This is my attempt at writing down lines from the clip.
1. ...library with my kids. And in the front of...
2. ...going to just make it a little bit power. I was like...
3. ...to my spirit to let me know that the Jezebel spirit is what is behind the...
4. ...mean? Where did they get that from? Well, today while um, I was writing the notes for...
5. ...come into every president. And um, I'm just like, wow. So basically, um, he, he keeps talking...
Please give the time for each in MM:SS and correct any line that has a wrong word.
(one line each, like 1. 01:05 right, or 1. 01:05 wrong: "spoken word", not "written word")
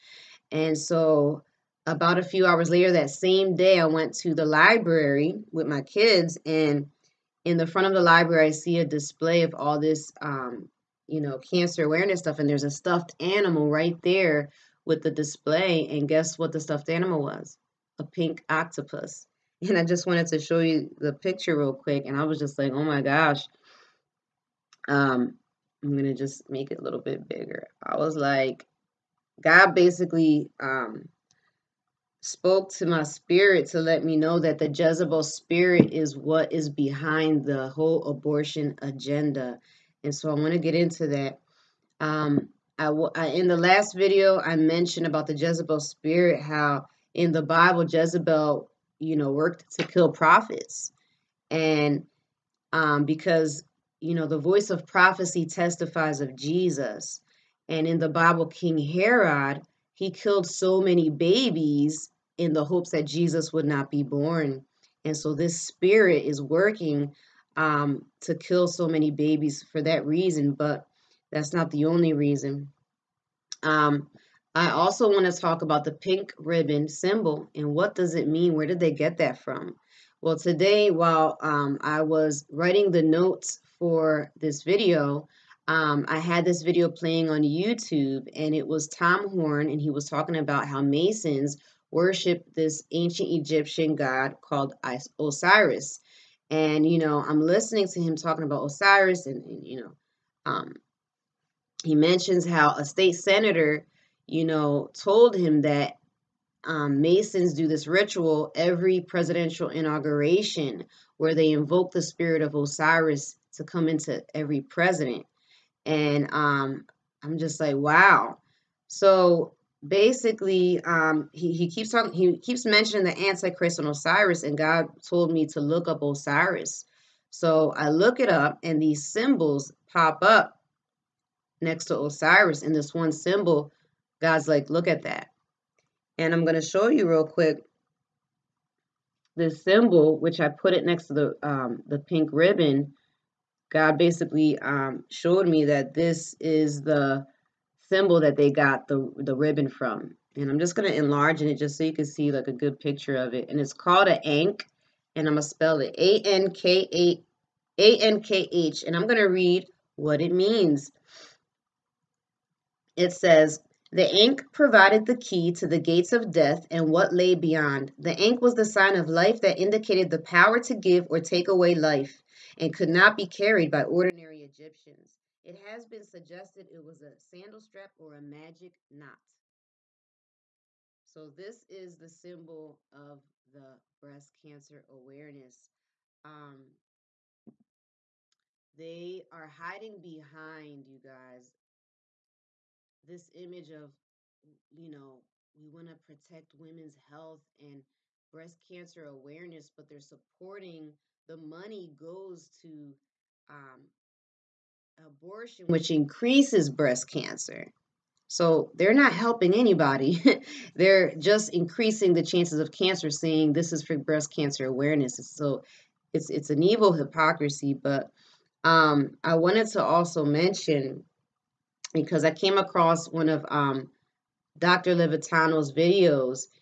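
1. 00:04 right
2. 00:25 wrong: "bigger", not "power"
3. 00:32 right
4. 01:18 right
5. 01:53 right.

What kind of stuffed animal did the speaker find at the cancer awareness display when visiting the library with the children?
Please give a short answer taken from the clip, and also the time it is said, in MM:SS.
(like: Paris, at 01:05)
A pink octopus, at 00:17.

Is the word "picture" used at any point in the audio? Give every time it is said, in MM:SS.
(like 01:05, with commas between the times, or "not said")
00:21, 02:32.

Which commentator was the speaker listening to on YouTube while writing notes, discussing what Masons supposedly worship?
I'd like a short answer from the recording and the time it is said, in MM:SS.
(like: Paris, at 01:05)
Tom Horn, at 01:28.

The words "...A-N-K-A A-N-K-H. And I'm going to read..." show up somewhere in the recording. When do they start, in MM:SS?
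02:35.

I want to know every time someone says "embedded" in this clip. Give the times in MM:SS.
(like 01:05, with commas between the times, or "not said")
not said.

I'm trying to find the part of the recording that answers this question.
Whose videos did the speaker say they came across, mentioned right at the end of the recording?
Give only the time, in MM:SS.
03:44.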